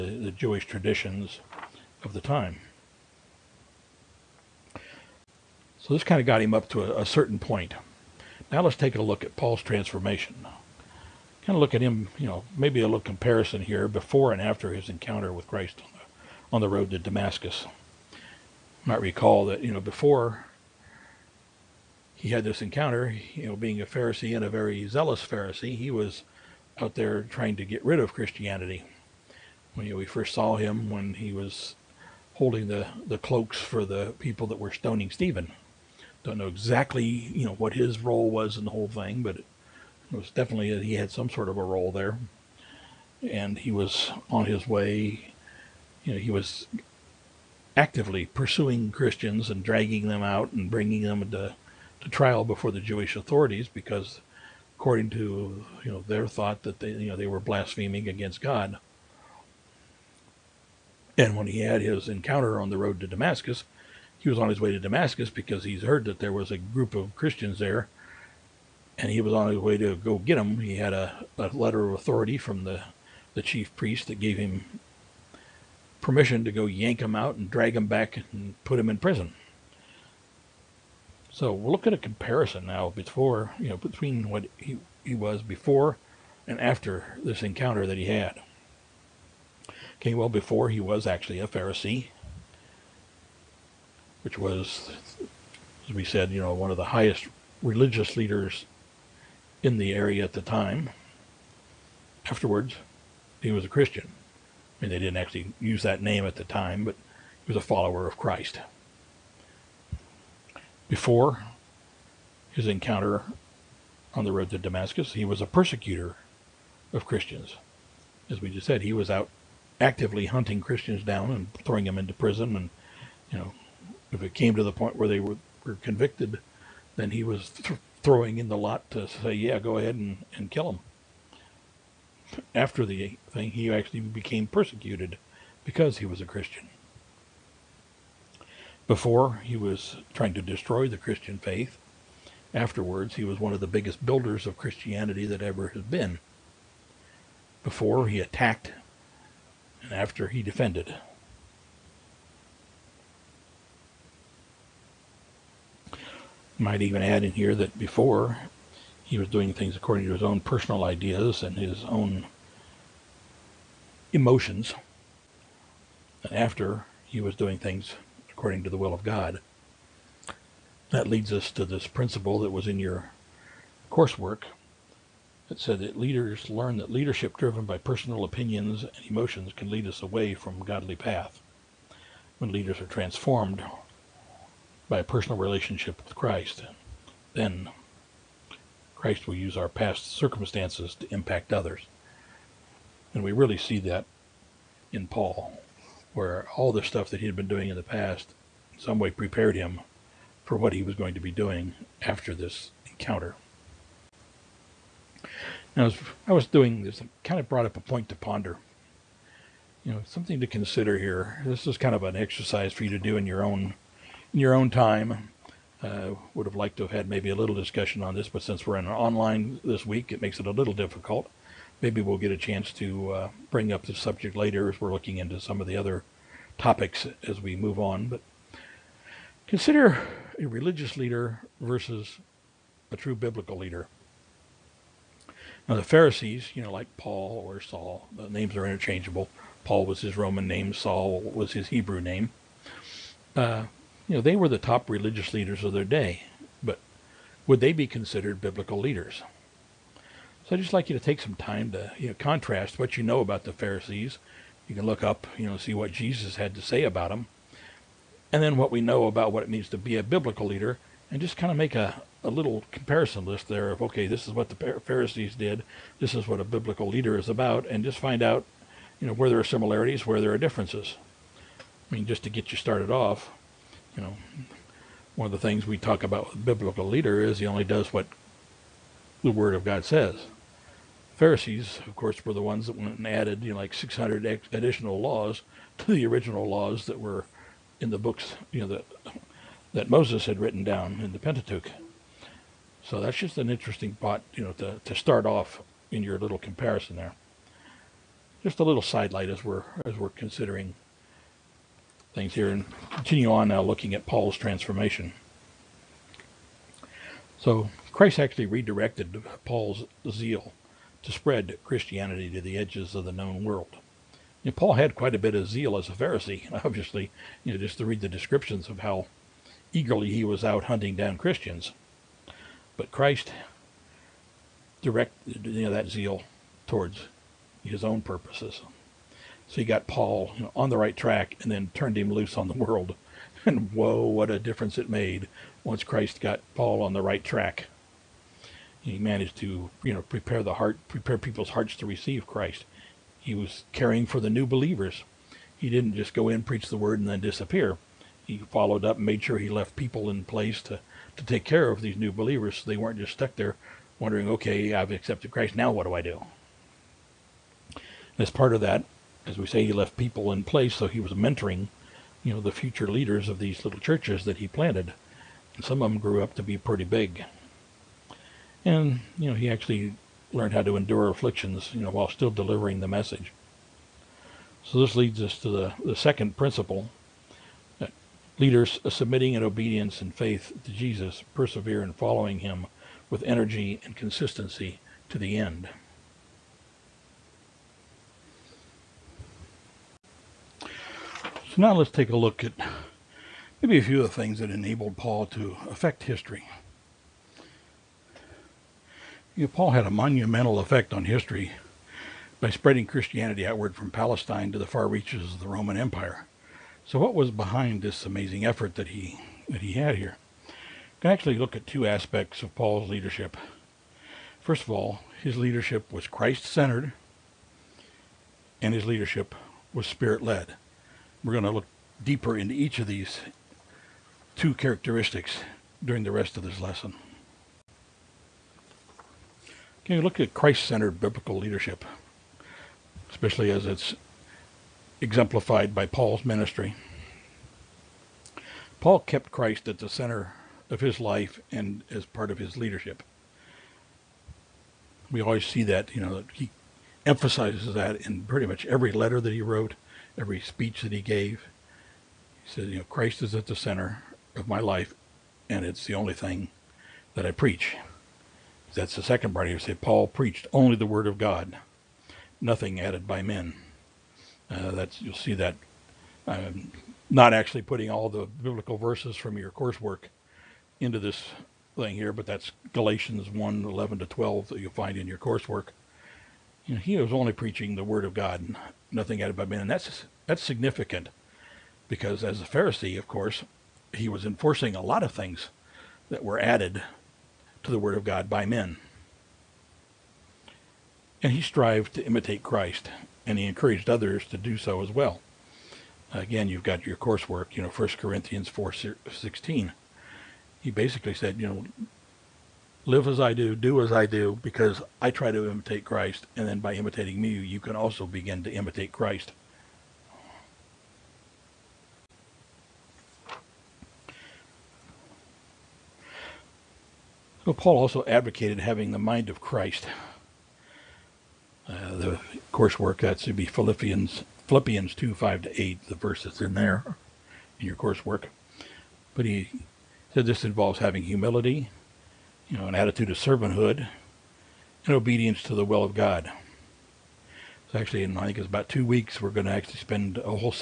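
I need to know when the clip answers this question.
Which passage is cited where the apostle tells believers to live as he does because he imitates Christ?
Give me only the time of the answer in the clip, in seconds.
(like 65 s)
497 s.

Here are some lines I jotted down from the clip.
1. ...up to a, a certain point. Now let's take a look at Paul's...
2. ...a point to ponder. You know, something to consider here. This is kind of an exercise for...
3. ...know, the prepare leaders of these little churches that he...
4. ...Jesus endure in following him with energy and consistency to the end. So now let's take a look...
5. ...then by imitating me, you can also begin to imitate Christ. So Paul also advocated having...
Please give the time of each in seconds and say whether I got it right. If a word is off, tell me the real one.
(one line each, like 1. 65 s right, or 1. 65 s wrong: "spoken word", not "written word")
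1. 6 s right
2. 207 s right
3. 362 s wrong: "future", not "prepare"
4. 380 s wrong: "persevere", not "endure"
5. 506 s right.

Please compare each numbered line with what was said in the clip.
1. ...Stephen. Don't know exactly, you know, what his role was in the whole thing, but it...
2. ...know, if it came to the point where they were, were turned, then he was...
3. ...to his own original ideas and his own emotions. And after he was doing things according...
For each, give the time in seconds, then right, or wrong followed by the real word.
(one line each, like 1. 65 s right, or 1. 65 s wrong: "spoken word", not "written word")
1. 35 s right
2. 123 s wrong: "convicted", not "turned"
3. 160 s wrong: "personal", not "original".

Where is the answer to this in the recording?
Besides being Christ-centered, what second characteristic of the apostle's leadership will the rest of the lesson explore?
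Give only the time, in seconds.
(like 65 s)
419 s.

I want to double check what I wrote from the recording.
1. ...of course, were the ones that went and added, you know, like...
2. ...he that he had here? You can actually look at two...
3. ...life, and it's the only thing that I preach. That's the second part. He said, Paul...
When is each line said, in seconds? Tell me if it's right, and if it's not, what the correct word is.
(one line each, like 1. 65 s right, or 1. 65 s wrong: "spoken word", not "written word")
1. 281 s right
2. 408 s right
3. 454 s right.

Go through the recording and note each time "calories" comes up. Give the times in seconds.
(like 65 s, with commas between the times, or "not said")
not said.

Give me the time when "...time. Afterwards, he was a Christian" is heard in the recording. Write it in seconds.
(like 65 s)
100 s.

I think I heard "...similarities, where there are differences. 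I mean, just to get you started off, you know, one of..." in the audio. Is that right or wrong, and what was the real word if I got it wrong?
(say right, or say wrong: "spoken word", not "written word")
right.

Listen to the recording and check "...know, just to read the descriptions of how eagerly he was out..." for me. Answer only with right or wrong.
right.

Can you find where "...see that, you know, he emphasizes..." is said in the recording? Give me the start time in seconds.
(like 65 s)
445 s.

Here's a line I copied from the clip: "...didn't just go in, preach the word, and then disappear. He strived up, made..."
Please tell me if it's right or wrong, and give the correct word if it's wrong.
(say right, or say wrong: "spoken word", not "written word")
wrong: "followed", not "strived".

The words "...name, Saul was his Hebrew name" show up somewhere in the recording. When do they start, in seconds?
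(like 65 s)
240 s.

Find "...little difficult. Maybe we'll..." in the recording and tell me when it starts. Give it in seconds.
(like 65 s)
220 s.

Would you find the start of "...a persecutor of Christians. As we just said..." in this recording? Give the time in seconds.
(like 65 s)
115 s.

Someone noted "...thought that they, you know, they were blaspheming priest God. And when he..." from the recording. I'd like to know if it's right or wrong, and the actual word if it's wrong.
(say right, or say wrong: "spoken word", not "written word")
wrong: "against", not "priest".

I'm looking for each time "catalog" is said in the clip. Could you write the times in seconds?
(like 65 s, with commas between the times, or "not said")
not said.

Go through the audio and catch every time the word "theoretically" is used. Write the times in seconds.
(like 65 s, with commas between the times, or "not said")
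not said.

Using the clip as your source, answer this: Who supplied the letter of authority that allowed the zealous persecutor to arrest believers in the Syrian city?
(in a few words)
the chief priest.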